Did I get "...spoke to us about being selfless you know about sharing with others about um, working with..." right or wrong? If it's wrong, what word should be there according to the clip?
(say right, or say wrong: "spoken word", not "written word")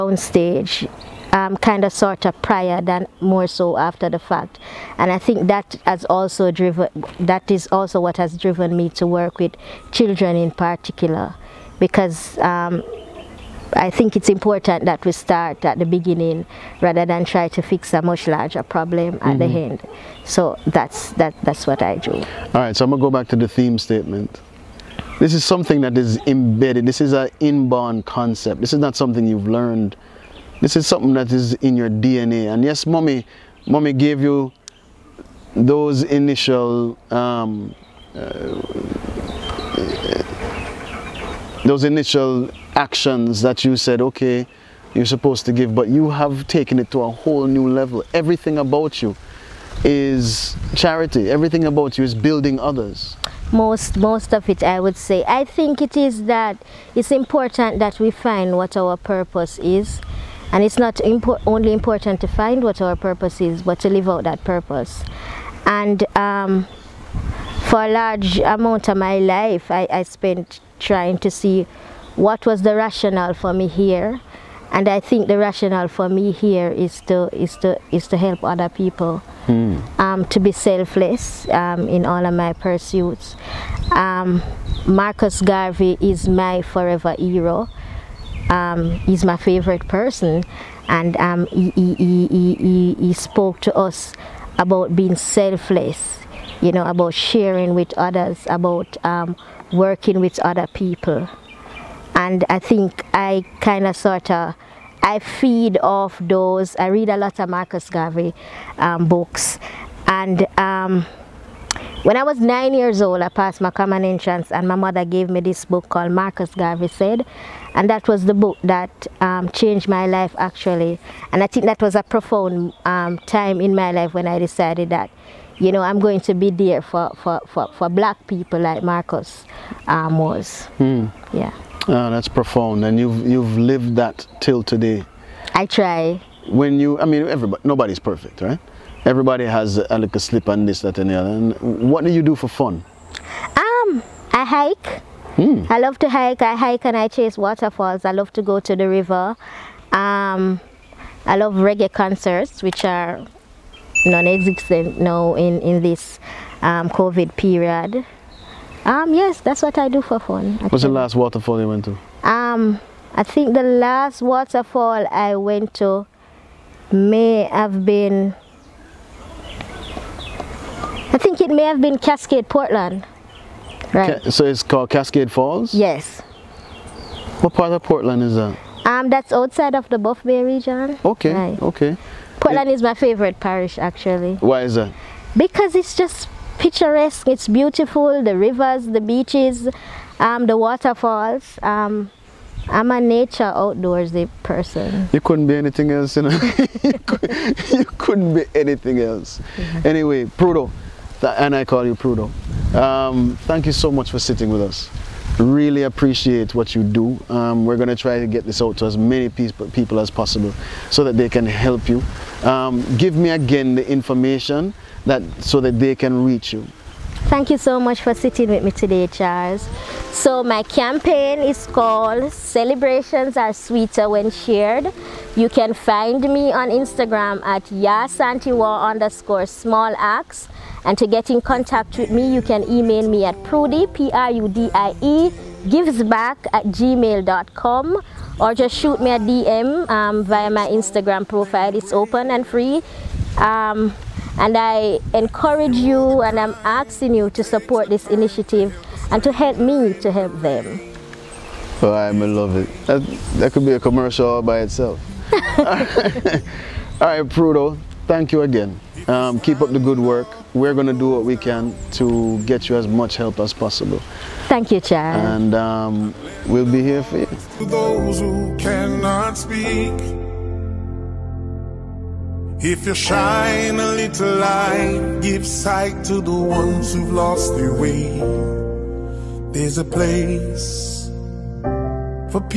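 right.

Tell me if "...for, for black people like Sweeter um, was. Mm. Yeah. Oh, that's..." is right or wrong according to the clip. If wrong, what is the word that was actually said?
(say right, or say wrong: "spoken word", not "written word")
wrong: "Marcus", not "Sweeter".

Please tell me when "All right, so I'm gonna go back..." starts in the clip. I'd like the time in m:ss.
0:22.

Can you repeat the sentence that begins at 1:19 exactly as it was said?
um, to be selfless um, in all of my pursuits.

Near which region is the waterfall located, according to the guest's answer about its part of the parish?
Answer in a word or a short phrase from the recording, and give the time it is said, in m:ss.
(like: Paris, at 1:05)
Buff Bay, at 2:59.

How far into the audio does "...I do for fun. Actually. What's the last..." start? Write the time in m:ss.
2:39.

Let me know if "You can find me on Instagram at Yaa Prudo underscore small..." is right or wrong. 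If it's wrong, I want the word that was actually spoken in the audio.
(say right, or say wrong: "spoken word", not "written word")
wrong: "Asantewaa", not "Prudo".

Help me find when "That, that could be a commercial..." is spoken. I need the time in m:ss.
4:12.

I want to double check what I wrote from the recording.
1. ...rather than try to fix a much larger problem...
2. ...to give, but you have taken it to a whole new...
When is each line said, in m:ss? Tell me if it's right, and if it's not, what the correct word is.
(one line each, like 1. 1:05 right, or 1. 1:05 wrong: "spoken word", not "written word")
1. 0:16 right
2. 0:45 right.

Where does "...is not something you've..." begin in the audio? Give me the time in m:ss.
0:28.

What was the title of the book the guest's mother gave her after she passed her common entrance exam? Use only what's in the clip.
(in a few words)
Marcus Garvey Said.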